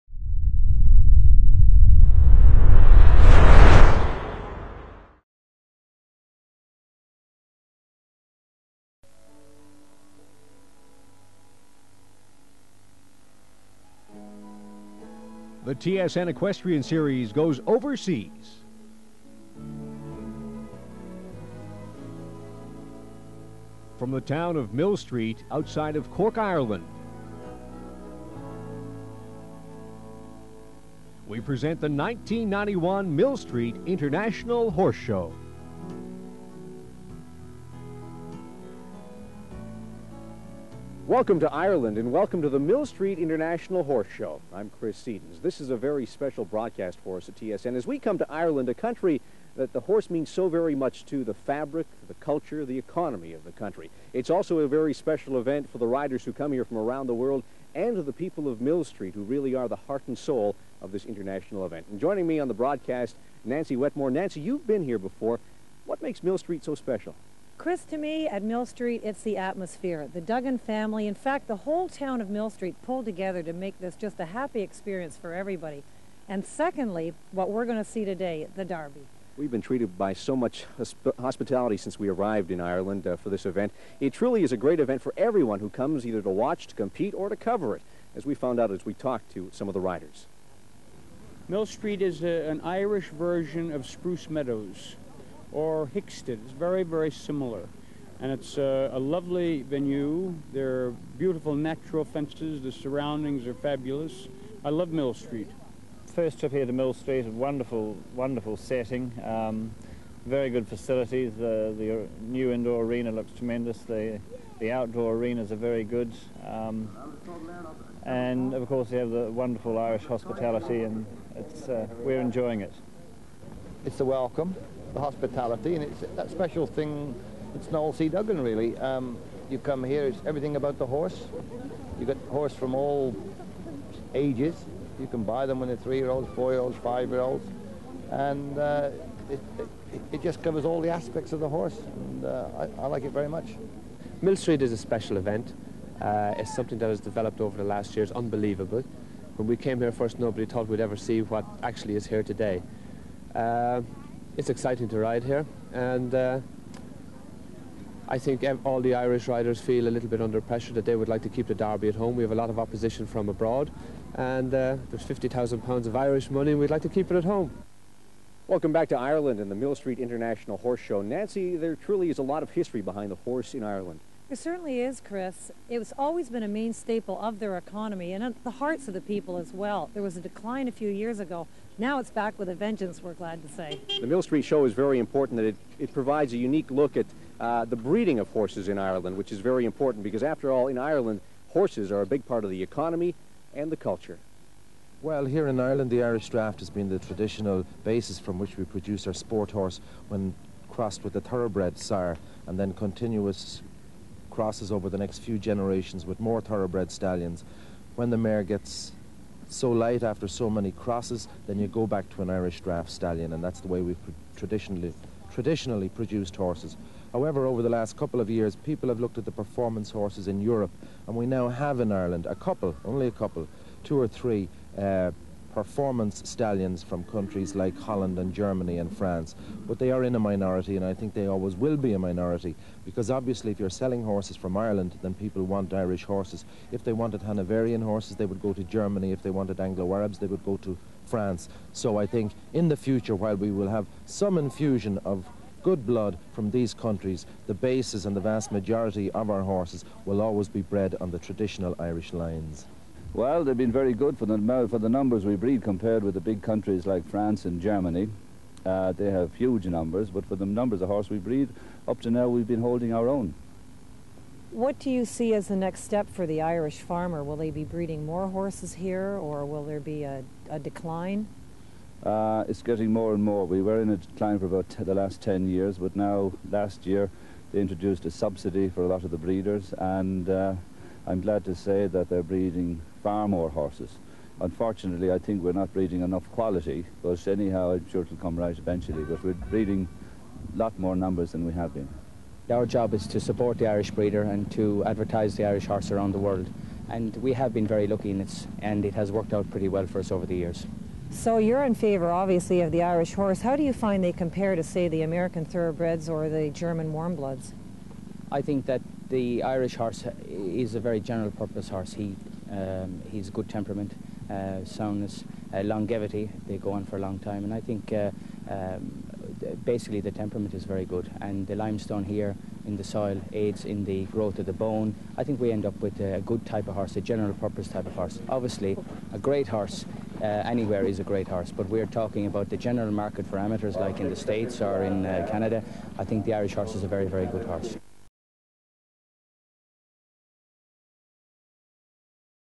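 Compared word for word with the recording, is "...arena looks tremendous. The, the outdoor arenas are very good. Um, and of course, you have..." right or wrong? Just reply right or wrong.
right.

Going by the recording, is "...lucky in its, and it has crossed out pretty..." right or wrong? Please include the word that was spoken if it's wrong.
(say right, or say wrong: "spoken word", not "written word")
wrong: "worked", not "crossed".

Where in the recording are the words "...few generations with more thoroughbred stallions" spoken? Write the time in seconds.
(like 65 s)
205 s.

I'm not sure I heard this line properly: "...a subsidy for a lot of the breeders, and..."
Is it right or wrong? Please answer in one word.
right.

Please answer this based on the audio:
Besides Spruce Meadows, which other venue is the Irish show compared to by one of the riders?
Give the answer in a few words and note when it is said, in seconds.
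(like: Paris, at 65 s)
Hickstead, at 95 s.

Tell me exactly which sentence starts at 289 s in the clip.
But we're breeding a lot more numbers than we have been.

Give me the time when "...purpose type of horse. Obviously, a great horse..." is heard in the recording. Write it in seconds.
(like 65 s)
327 s.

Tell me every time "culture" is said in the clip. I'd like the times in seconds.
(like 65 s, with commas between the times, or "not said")
52 s, 193 s.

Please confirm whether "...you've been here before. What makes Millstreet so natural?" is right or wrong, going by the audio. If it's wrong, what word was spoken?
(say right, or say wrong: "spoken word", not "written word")
wrong: "special", not "natural".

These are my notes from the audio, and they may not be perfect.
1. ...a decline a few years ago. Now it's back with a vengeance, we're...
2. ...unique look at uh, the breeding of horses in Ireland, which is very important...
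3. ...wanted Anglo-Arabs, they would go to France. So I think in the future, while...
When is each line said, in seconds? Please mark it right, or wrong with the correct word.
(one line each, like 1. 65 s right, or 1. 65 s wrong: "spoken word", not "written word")
1. 180 s right
2. 186 s right
3. 239 s right.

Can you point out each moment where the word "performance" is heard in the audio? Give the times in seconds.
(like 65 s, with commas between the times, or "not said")
219 s, 225 s.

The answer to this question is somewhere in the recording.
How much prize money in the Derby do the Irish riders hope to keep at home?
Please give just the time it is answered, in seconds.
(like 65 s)
165 s.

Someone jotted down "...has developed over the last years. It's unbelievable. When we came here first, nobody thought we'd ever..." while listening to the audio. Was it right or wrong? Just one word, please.
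right.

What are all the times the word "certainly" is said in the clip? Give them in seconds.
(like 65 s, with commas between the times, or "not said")
174 s.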